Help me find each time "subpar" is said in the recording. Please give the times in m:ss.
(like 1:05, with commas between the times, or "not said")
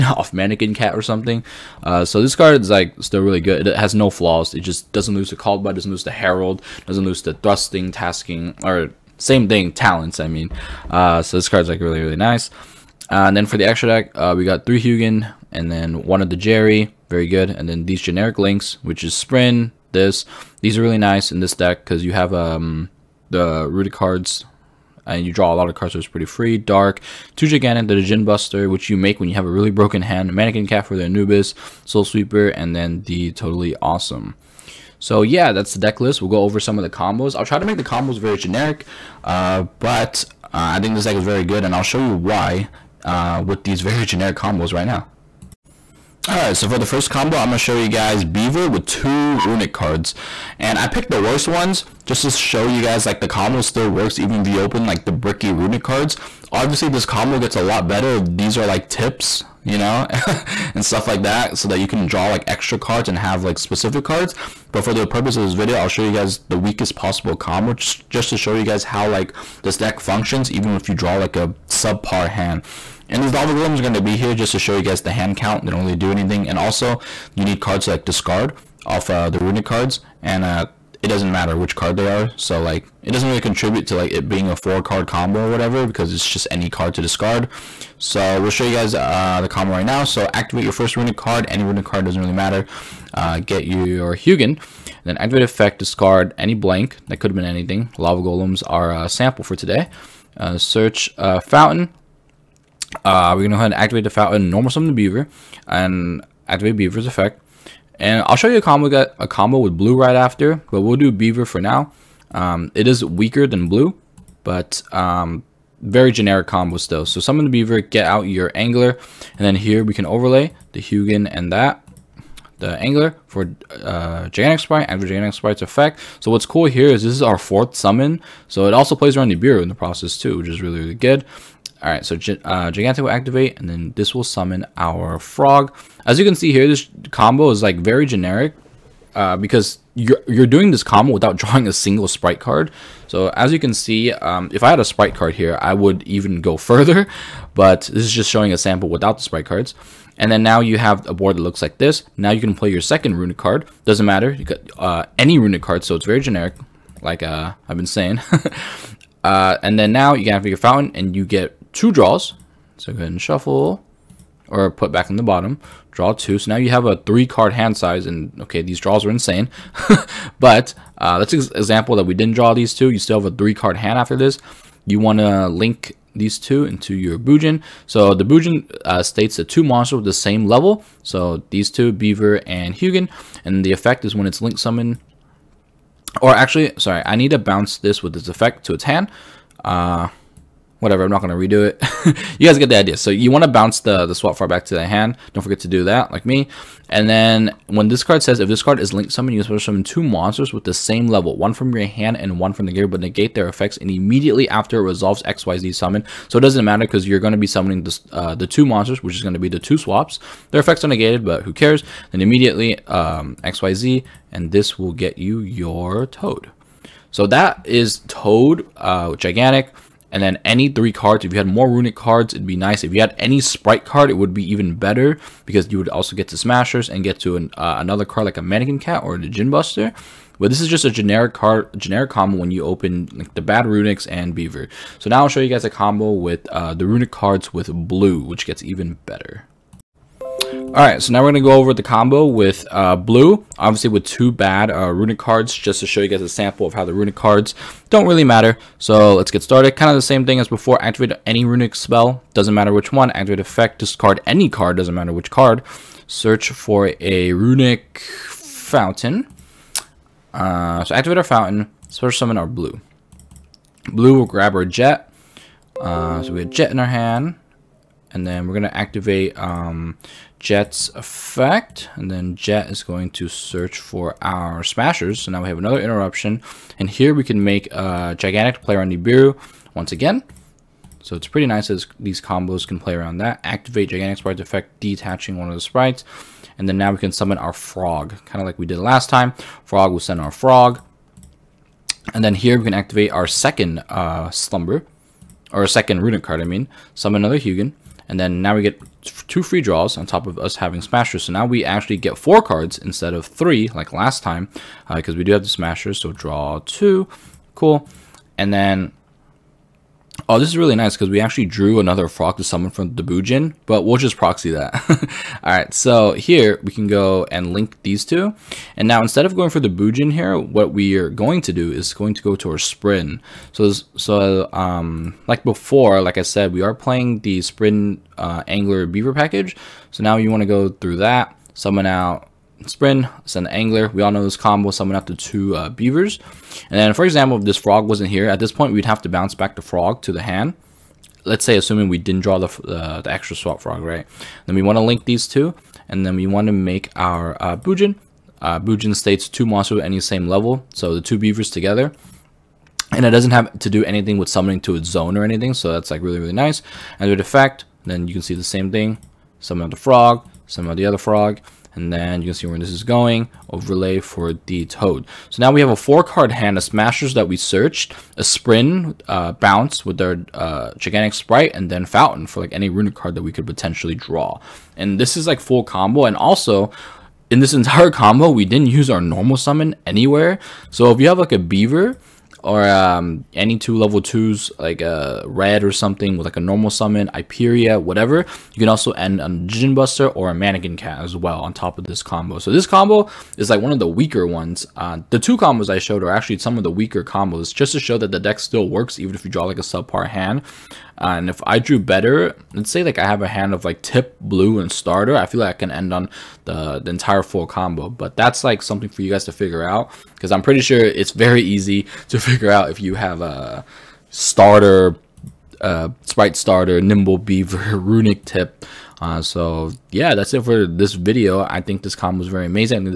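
1:11, 6:39.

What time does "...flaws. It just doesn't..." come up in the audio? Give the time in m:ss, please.
0:04.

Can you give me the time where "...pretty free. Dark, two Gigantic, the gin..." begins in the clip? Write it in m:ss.
0:26.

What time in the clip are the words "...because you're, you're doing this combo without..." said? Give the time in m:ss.
2:19.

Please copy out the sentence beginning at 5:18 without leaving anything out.
And now instead of going for the Bujin here, what we are going to do is going to go to our Sprind.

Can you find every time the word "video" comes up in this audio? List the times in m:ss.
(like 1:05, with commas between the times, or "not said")
1:05, 7:00.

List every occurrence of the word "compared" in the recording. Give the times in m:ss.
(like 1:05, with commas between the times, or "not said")
not said.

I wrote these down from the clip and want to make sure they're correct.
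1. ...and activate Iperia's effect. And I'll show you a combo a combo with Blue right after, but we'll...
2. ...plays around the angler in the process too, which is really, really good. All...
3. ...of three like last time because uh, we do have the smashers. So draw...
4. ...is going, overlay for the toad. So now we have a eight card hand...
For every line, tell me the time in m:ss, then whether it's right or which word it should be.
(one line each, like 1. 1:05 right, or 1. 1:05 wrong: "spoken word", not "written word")
1. 1:45 wrong: "Beaver", not "Iperia"
2. 2:08 wrong: "beaver", not "angler"
3. 5:03 right
4. 6:02 wrong: "four", not "eight".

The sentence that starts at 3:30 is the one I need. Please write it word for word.
Their effects are negated, but who cares?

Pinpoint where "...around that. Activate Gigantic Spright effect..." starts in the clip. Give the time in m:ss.
4:42.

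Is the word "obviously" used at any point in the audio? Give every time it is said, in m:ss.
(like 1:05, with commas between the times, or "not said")
0:56, 4:03.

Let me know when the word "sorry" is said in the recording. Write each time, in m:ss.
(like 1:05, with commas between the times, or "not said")
3:06.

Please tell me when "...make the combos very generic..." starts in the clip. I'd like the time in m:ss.
0:37.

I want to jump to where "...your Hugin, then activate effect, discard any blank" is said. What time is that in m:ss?
1:33.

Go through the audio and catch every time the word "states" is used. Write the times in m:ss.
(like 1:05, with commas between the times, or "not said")
2:59, 5:48.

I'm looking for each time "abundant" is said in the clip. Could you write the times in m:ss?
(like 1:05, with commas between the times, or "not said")
not said.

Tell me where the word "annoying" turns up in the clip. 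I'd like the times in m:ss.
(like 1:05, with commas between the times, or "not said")
not said.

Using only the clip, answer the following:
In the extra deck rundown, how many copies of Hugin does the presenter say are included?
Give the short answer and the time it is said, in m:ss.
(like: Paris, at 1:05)
3, at 0:14.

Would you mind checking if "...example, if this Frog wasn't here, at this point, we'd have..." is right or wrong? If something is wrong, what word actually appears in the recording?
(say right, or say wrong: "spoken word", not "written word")
right.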